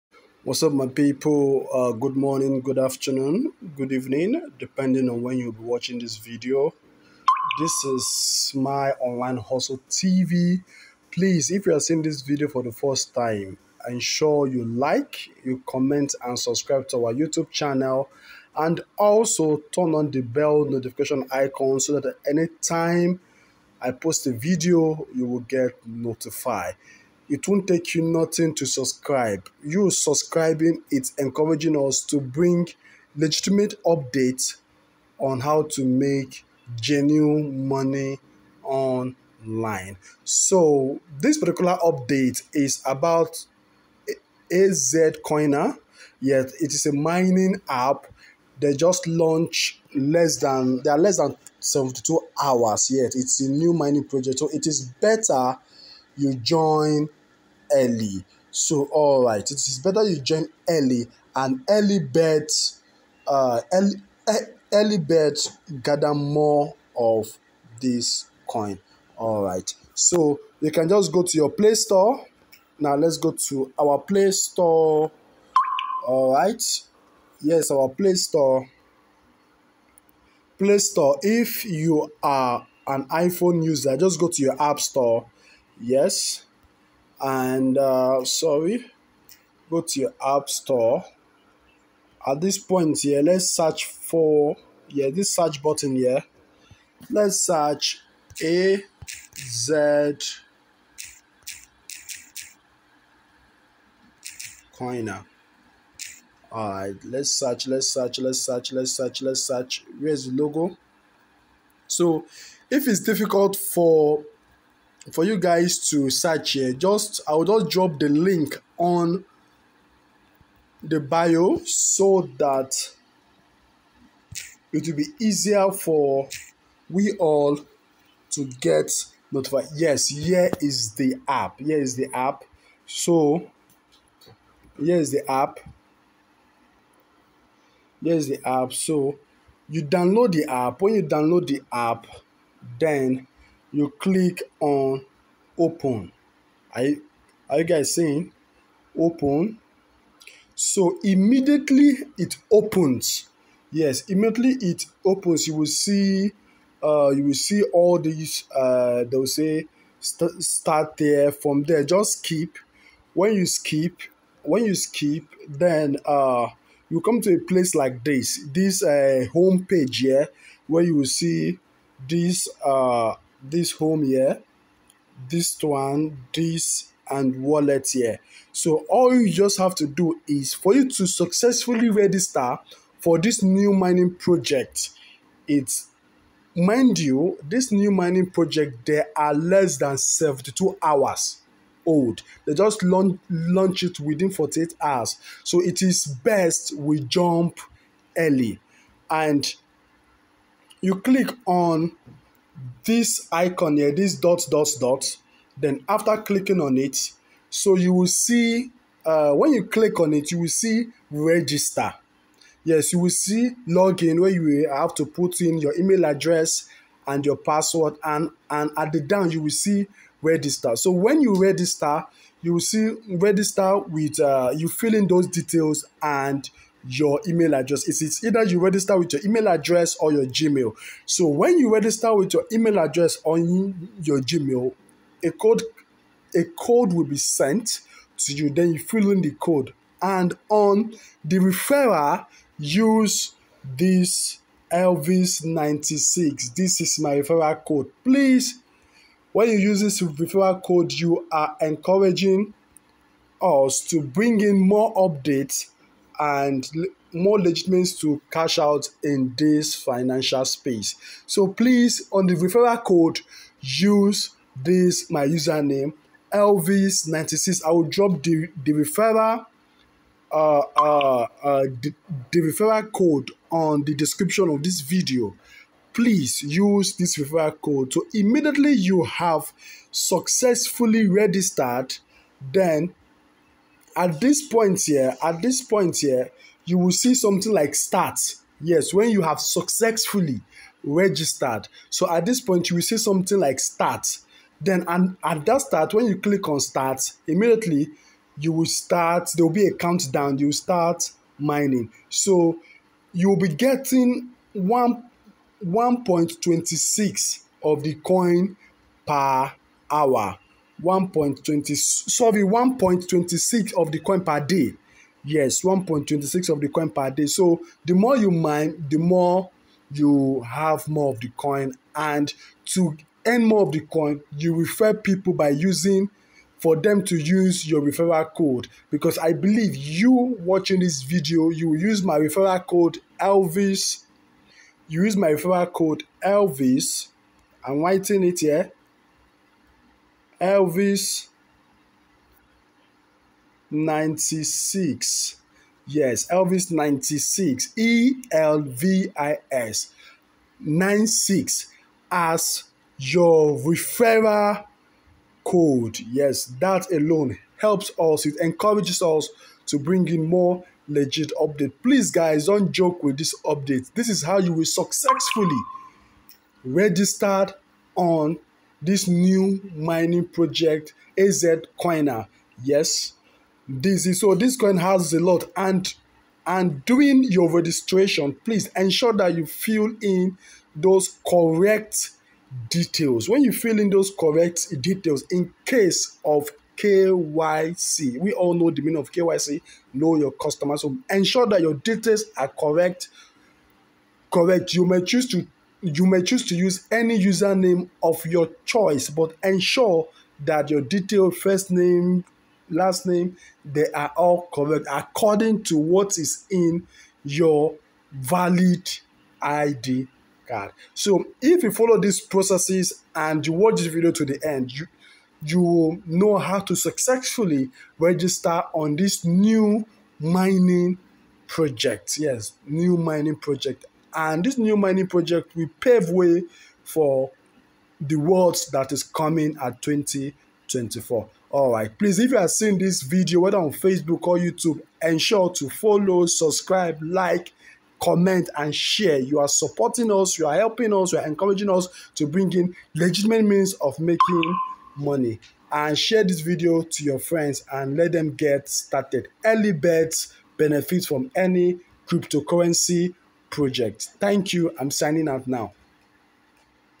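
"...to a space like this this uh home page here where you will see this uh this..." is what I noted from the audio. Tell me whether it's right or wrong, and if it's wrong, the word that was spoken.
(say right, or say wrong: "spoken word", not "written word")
wrong: "place", not "space".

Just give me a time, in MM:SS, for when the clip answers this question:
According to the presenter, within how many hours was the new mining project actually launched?
03:14.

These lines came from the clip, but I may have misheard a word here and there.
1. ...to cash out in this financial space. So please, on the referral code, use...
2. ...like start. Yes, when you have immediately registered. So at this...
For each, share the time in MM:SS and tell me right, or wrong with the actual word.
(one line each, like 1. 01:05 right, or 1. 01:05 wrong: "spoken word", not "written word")
1. 04:17 right
2. 04:47 wrong: "successfully", not "immediately".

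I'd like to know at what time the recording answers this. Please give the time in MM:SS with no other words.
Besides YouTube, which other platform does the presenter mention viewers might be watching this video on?
07:13.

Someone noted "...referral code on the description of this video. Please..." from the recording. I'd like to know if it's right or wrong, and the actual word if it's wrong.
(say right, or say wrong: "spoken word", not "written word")
right.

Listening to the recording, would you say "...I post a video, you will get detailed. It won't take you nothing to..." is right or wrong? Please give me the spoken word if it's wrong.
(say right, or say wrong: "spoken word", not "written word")
wrong: "notified", not "detailed".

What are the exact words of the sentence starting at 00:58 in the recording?
So, all right, it is better you join early and early birds, uh, early, early birds gather more of this coin.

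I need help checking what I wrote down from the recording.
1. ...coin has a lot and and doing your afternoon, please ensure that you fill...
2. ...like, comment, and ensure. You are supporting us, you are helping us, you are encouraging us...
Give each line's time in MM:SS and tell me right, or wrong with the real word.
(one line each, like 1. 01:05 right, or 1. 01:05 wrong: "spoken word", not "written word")
1. 06:14 wrong: "registration", not "afternoon"
2. 07:17 wrong: "share", not "ensure".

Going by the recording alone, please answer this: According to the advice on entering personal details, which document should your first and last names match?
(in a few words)
Valid ID card.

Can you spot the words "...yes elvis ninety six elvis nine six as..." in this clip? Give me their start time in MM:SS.
05:45.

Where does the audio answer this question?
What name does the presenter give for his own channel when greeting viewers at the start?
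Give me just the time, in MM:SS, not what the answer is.
00:08.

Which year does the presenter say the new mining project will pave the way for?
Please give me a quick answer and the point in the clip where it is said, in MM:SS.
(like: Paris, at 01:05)
2024, at 07:09.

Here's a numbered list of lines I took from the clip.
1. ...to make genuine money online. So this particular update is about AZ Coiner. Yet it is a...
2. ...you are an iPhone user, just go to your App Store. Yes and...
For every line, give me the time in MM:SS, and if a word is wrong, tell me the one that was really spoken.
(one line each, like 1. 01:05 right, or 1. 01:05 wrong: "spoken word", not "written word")
1. 00:35 right
2. 01:21 right.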